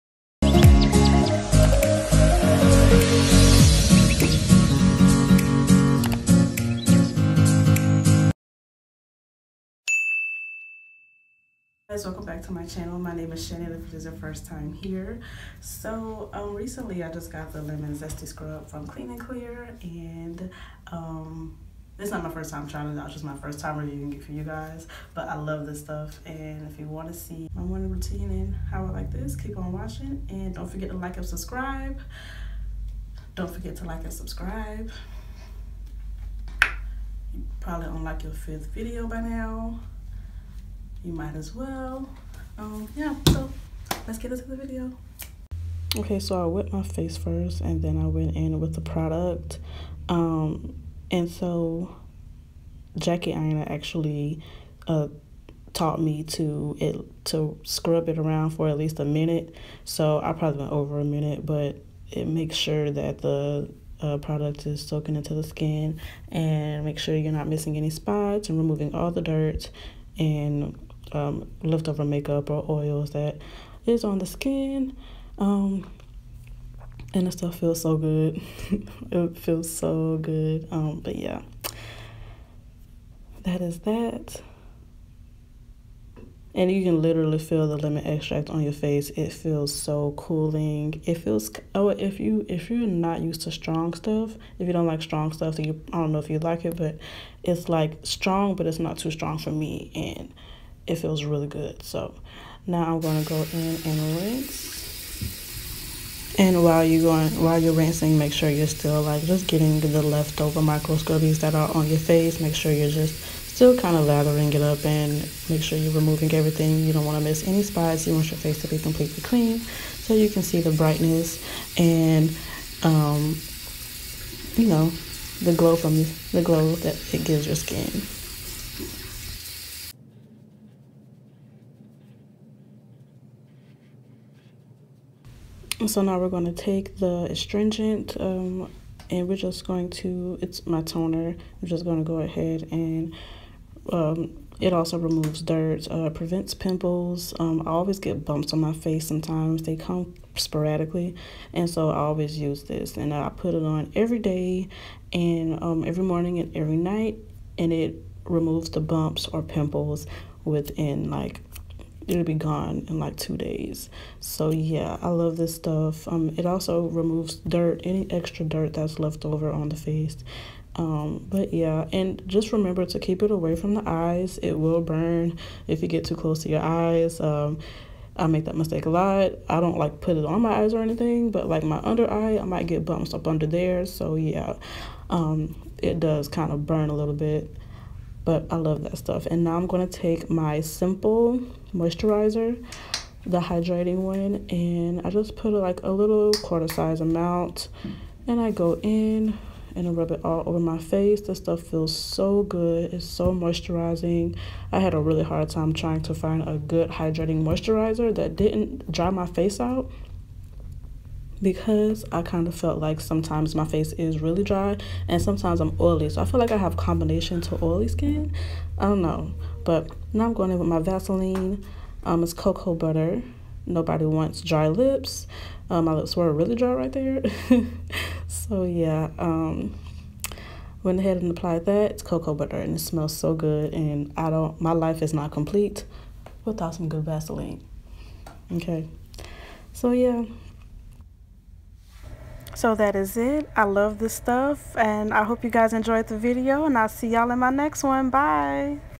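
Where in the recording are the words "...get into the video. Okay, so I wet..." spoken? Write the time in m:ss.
0:44.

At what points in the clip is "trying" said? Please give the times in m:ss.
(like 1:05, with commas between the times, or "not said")
0:22, 3:25.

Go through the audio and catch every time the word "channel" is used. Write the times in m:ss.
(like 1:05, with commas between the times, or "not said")
0:12.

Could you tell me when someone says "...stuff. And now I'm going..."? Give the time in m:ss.
3:08.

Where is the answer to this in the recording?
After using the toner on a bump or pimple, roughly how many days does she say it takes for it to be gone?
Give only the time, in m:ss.
2:43.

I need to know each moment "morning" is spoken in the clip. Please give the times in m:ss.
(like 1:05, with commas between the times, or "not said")
0:27, 2:36.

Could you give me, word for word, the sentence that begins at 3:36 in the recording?
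So I feel like I have combination to oily skin.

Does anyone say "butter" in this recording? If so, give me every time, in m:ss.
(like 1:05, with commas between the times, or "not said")
3:42, 3:52.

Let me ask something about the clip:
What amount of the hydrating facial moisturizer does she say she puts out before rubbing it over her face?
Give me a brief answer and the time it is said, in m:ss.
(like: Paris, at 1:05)
quarter size, at 3:16.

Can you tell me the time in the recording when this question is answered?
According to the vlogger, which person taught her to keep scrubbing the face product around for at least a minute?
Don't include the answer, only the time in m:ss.
0:52.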